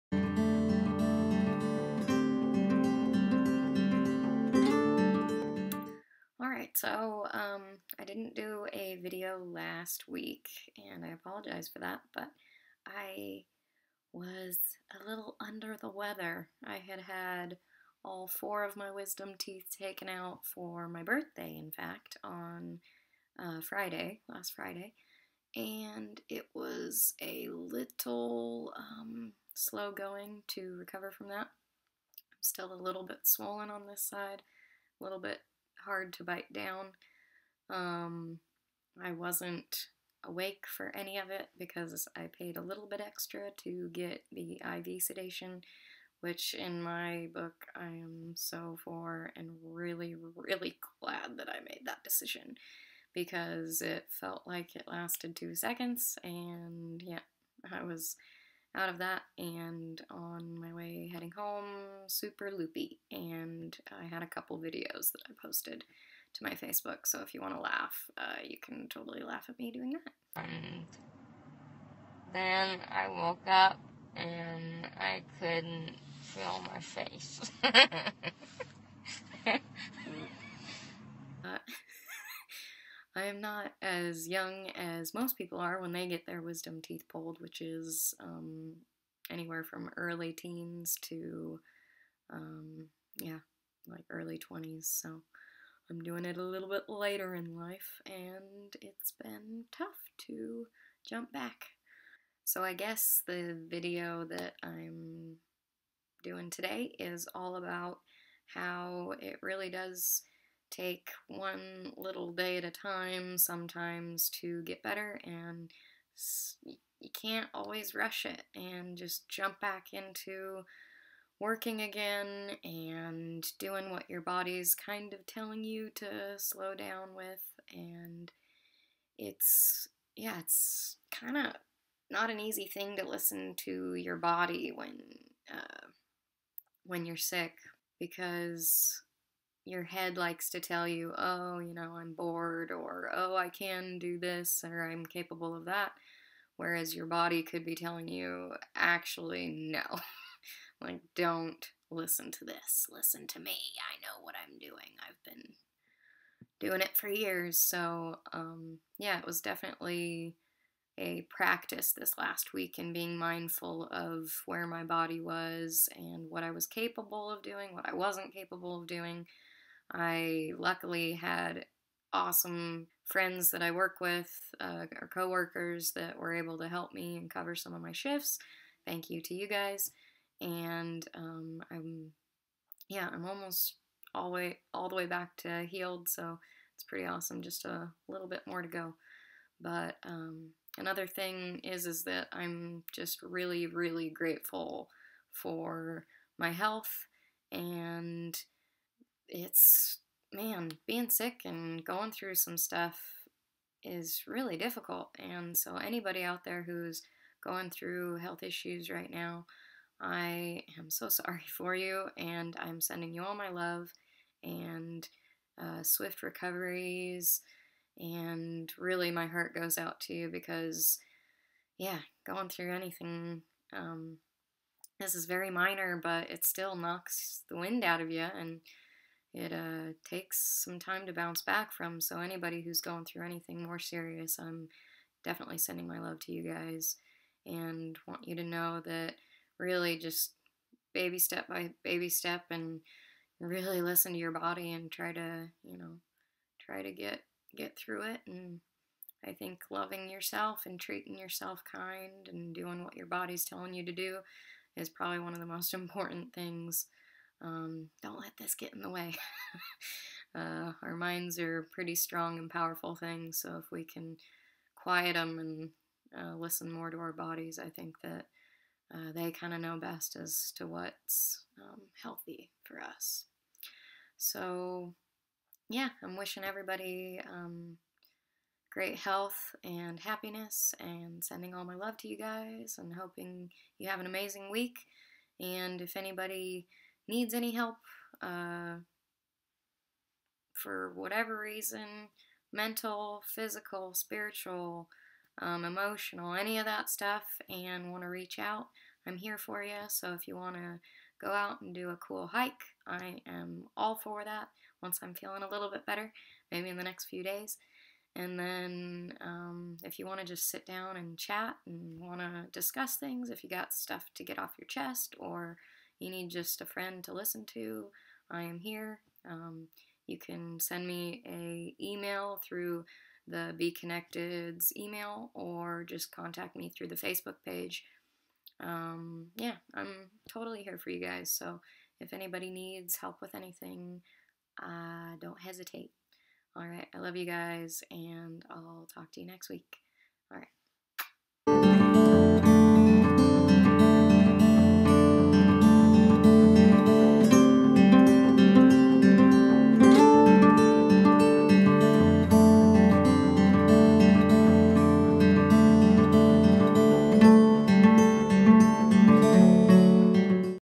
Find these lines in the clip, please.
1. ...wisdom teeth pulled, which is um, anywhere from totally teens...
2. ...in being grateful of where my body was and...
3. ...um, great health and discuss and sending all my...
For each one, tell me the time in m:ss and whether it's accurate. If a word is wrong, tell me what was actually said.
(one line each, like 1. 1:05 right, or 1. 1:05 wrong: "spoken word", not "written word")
1. 1:26 wrong: "early", not "totally"
2. 2:42 wrong: "mindful", not "grateful"
3. 4:37 wrong: "happiness", not "discuss".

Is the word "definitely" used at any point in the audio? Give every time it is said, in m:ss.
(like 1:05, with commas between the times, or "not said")
2:39, 3:55.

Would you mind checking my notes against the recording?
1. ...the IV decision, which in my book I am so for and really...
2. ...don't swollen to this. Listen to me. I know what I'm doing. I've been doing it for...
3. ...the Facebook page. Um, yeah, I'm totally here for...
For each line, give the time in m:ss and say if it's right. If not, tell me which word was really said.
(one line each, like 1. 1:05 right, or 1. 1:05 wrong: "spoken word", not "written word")
1. 0:44 wrong: "sedation", not "decision"
2. 2:31 wrong: "listen", not "swollen"
3. 5:26 right.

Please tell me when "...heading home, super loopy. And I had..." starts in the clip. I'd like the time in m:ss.
1:01.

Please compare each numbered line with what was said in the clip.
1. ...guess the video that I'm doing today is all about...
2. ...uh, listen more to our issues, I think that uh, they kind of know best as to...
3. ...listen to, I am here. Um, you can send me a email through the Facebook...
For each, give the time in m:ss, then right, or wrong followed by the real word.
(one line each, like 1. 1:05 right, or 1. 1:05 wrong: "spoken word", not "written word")
1. 1:42 right
2. 4:26 wrong: "bodies", not "issues"
3. 5:17 wrong: "Bee", not "Facebook".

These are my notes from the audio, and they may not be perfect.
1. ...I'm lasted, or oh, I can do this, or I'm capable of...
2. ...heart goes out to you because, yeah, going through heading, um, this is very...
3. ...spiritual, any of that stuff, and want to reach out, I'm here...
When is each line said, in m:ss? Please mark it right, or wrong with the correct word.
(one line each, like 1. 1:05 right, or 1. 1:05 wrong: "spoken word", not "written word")
1. 2:21 wrong: "bored", not "lasted"
2. 3:39 wrong: "anything", not "heading"
3. 4:55 wrong: "emotional", not "spiritual".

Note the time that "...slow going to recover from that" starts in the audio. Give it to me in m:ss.
0:29.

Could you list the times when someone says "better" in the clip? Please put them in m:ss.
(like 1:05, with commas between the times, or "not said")
1:54, 5:05.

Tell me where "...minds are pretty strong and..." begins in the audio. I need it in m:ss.
4:20.